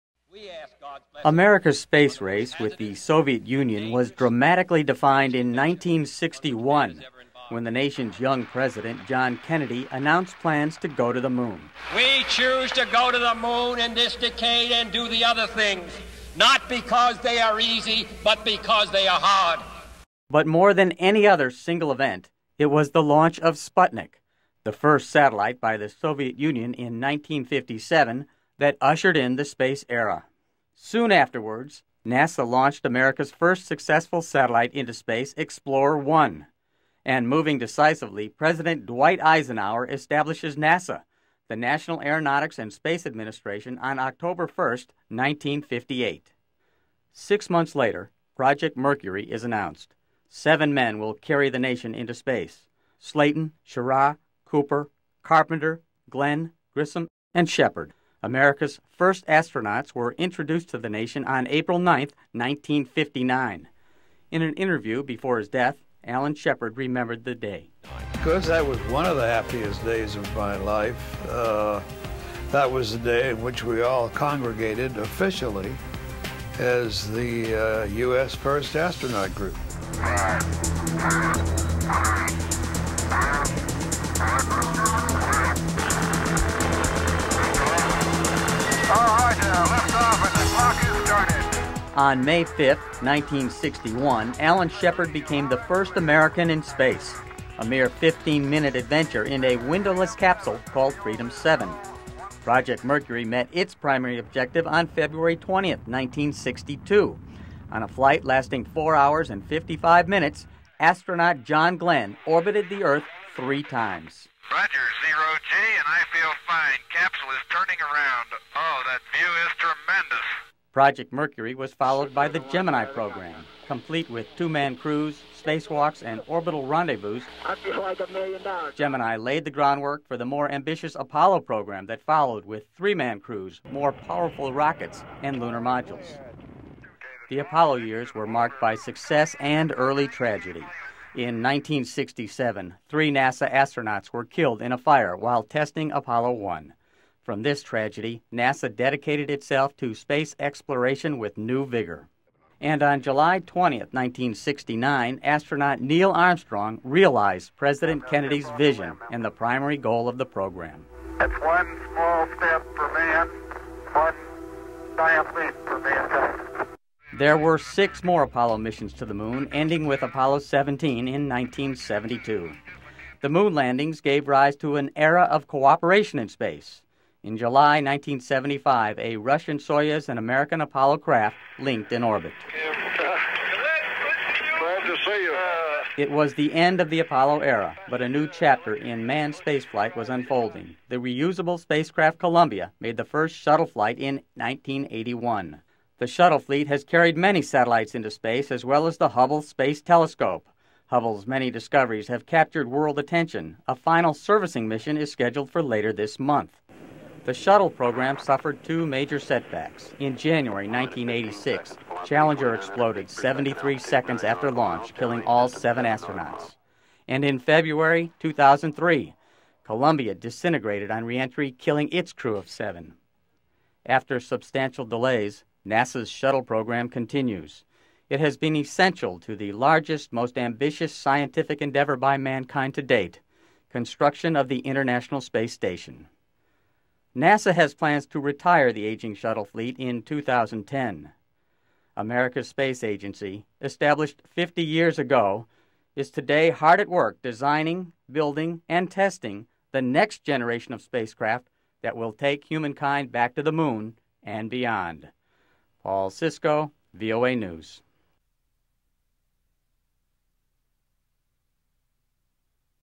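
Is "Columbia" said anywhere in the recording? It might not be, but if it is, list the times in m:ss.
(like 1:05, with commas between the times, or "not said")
3:12, 3:39.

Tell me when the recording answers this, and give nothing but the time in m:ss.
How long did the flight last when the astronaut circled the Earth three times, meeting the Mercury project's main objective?
1:48.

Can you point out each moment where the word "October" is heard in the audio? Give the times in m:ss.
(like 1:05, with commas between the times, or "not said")
0:43.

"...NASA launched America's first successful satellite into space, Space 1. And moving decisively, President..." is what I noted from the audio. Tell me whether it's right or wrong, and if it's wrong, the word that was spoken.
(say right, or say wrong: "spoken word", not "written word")
wrong: "Explorer", not "Space".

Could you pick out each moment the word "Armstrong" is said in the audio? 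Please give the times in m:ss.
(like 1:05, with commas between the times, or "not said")
2:36.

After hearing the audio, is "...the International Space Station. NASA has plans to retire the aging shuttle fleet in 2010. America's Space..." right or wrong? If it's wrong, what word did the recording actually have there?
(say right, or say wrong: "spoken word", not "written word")
right.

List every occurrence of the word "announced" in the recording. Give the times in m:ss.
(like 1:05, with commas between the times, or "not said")
0:09, 0:49.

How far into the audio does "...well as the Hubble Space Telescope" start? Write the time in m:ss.
3:18.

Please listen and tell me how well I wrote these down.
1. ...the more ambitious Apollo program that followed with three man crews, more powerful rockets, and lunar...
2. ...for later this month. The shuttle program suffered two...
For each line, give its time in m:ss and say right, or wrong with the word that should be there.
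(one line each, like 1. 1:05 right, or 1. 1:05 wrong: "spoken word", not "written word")
1. 2:10 right
2. 3:25 right.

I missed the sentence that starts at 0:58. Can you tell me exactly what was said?
America's first astronauts were introduced to the nation on April 9, 1959.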